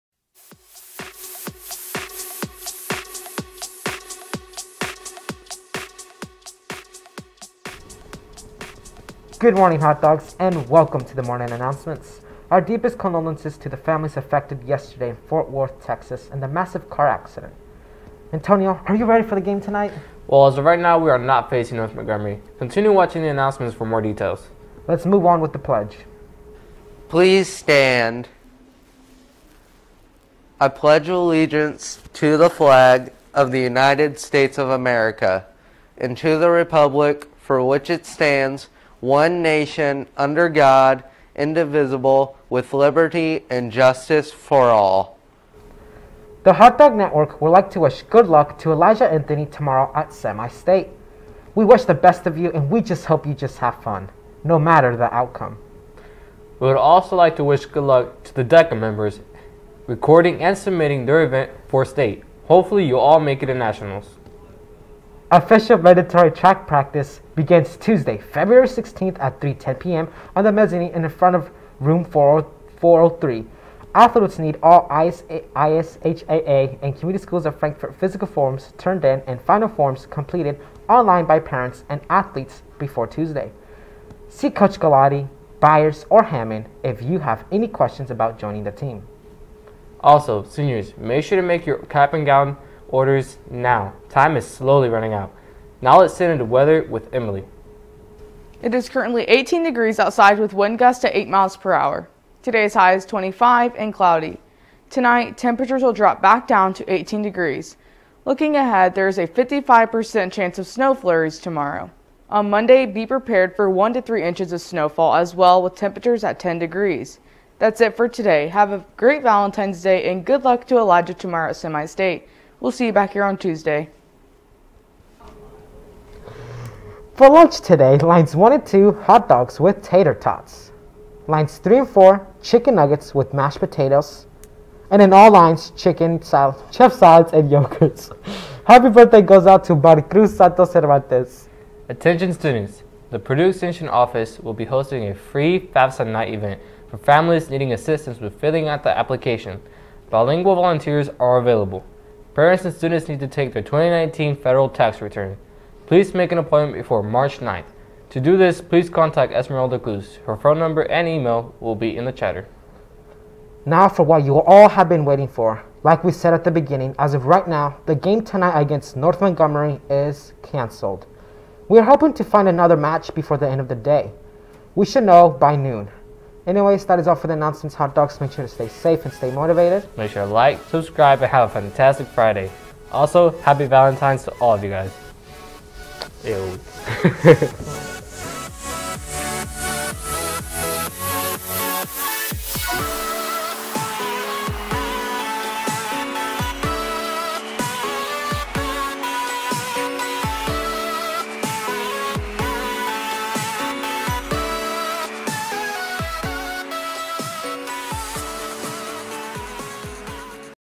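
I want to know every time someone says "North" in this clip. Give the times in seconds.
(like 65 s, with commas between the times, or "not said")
21 s, 168 s.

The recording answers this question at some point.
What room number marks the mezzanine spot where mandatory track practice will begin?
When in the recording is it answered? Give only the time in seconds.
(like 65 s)
72 s.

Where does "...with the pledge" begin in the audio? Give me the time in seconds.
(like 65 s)
25 s.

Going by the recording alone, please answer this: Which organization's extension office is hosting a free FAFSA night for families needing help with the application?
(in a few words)
Purdue.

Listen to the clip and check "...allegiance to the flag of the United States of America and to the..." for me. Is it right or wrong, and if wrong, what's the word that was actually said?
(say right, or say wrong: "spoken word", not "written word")
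right.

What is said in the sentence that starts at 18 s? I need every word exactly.
Antonio, are you ready for the game tonight?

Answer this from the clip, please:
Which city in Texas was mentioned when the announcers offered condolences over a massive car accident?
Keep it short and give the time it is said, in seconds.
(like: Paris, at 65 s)
Fort Worth, at 15 s.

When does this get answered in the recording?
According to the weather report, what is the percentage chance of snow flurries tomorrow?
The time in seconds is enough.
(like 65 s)
109 s.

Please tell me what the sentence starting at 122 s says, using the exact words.
We'll see you back here on Tuesday.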